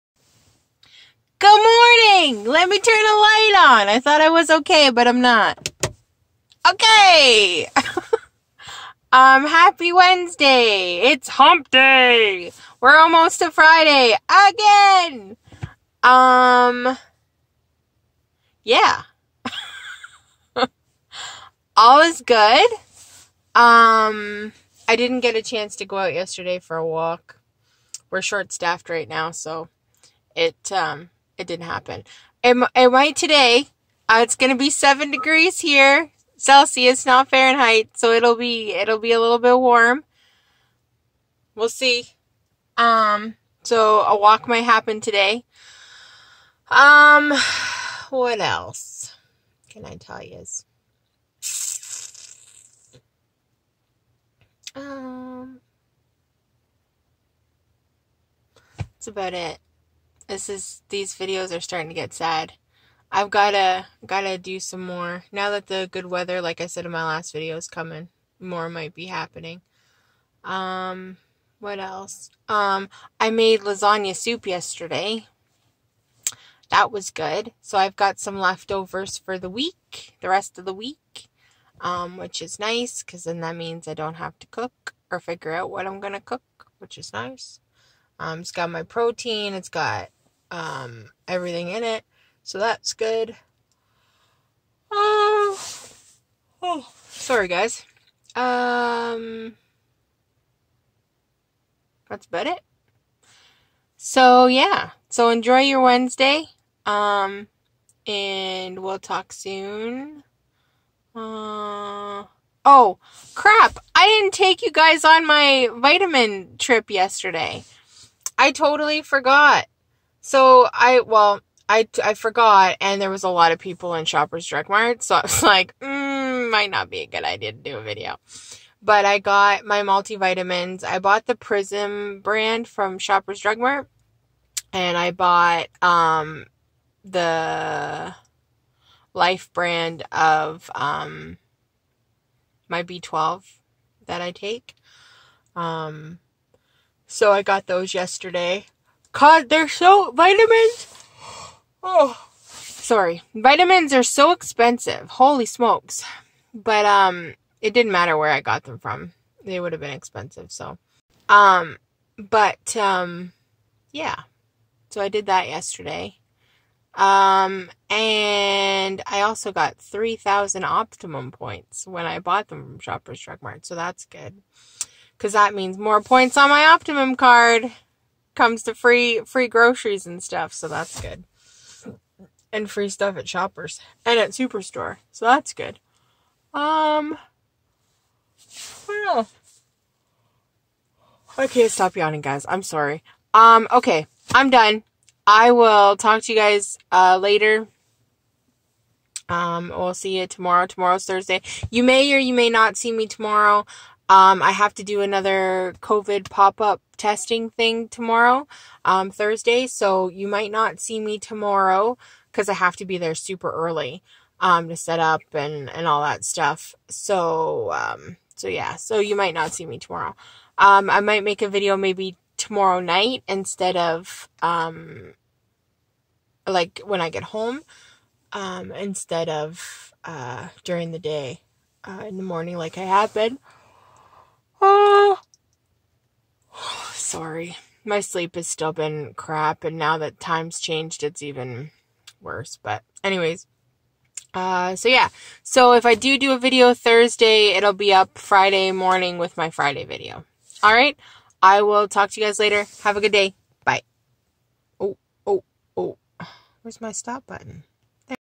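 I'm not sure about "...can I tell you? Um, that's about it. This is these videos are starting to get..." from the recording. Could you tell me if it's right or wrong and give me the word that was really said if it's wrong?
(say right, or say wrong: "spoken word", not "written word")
right.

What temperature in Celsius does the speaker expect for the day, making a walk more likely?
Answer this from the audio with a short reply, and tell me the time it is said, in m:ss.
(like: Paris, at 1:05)
7 degrees, at 0:34.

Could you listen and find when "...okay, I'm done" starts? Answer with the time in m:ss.
3:13.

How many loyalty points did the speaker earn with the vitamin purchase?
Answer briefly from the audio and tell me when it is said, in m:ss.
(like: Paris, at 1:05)
3000, at 2:49.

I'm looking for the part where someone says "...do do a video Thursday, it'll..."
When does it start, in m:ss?
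4:05.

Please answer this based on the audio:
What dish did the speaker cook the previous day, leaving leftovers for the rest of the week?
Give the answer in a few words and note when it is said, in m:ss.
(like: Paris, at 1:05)
Lasagna soup, at 1:13.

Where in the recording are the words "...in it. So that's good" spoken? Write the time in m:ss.
1:31.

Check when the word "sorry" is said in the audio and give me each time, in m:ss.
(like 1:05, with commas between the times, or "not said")
1:37, 2:32, 3:12, 3:57.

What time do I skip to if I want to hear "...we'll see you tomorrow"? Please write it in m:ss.
3:19.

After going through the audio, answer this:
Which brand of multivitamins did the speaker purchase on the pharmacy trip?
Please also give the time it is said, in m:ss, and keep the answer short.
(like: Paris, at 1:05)
Prism, at 2:11.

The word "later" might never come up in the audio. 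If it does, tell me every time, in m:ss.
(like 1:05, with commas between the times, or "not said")
3:17, 4:12.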